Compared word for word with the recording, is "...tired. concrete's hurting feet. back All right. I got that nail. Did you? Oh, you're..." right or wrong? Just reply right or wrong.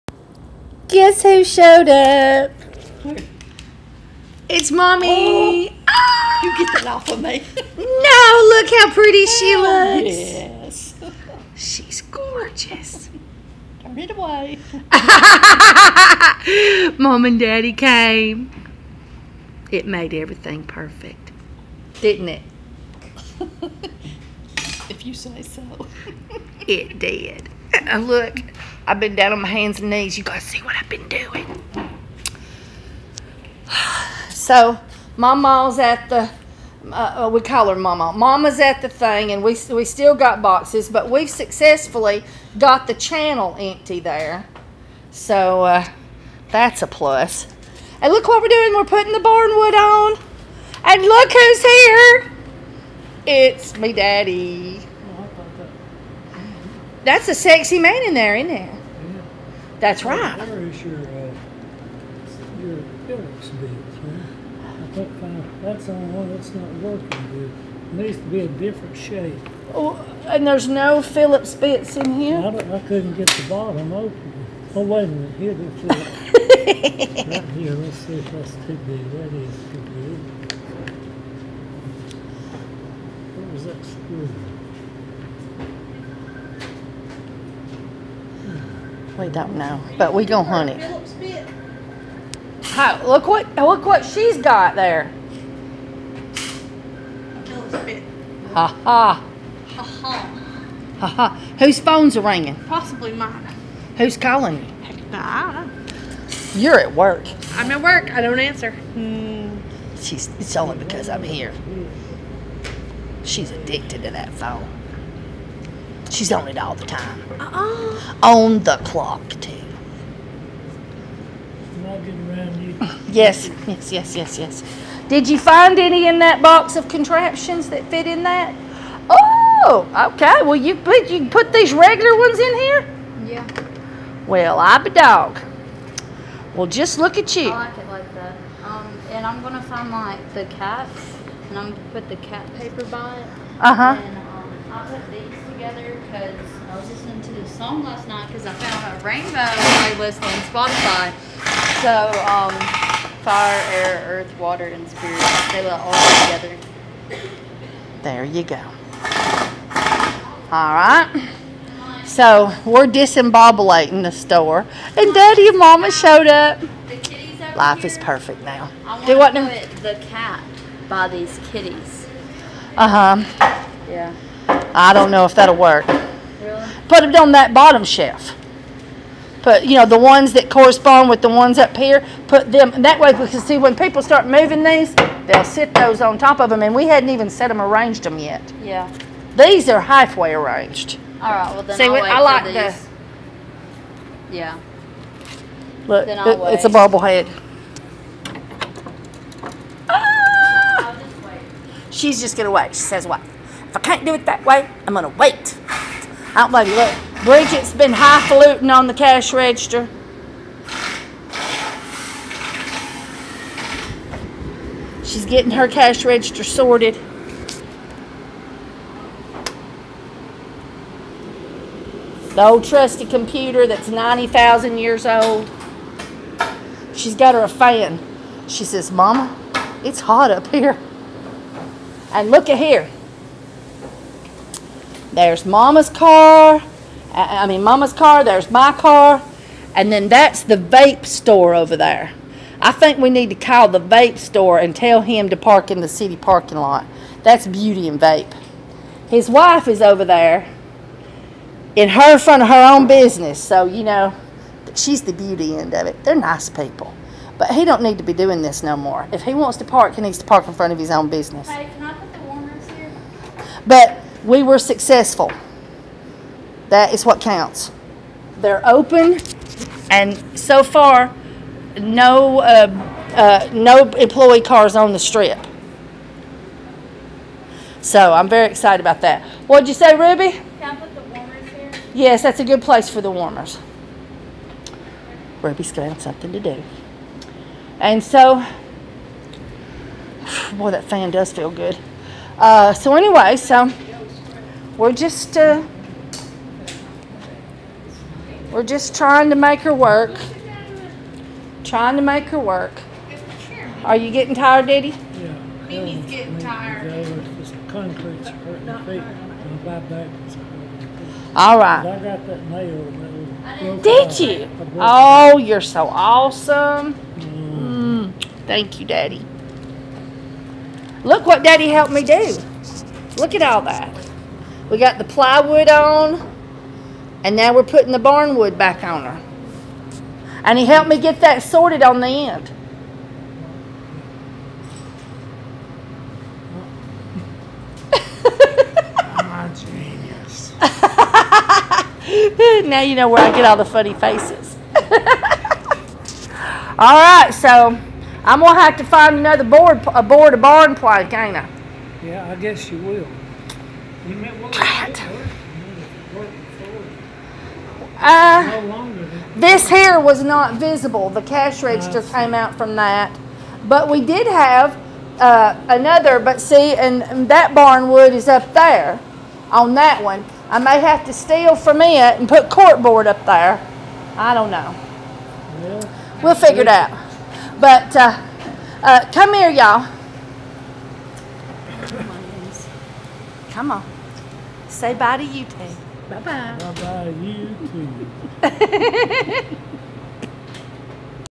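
right.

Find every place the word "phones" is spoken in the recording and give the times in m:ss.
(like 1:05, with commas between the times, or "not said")
1:41, 1:54.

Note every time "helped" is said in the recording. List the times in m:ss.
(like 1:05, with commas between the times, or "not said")
5:21, 5:30.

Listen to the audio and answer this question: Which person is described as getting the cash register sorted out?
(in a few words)
Bridget.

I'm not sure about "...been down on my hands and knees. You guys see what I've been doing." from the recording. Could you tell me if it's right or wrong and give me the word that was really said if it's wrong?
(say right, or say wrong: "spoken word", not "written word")
right.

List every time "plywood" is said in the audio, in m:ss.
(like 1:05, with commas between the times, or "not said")
5:25.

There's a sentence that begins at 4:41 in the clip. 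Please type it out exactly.
Yes, that's a good place for the warmers.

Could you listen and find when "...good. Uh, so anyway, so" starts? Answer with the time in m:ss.
4:51.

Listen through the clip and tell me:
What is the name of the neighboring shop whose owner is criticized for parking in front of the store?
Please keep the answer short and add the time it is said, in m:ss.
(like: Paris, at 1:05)
Beauty and Vape, at 4:07.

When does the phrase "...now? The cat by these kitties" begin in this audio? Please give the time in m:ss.
2:49.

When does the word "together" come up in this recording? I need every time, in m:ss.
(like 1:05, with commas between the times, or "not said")
2:25, 2:36.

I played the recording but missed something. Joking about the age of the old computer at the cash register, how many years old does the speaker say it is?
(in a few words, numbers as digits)
90,000.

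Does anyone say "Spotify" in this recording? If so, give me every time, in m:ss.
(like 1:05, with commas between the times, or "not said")
2:30.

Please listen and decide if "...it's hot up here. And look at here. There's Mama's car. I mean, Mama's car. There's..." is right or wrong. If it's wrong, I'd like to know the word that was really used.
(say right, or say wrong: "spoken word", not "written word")
right.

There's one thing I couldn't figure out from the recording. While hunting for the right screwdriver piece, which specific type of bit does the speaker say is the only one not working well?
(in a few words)
Phillips bit.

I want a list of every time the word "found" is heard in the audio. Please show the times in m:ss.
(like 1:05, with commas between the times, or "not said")
2:28.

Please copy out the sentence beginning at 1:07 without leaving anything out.
It needs to be a different shape.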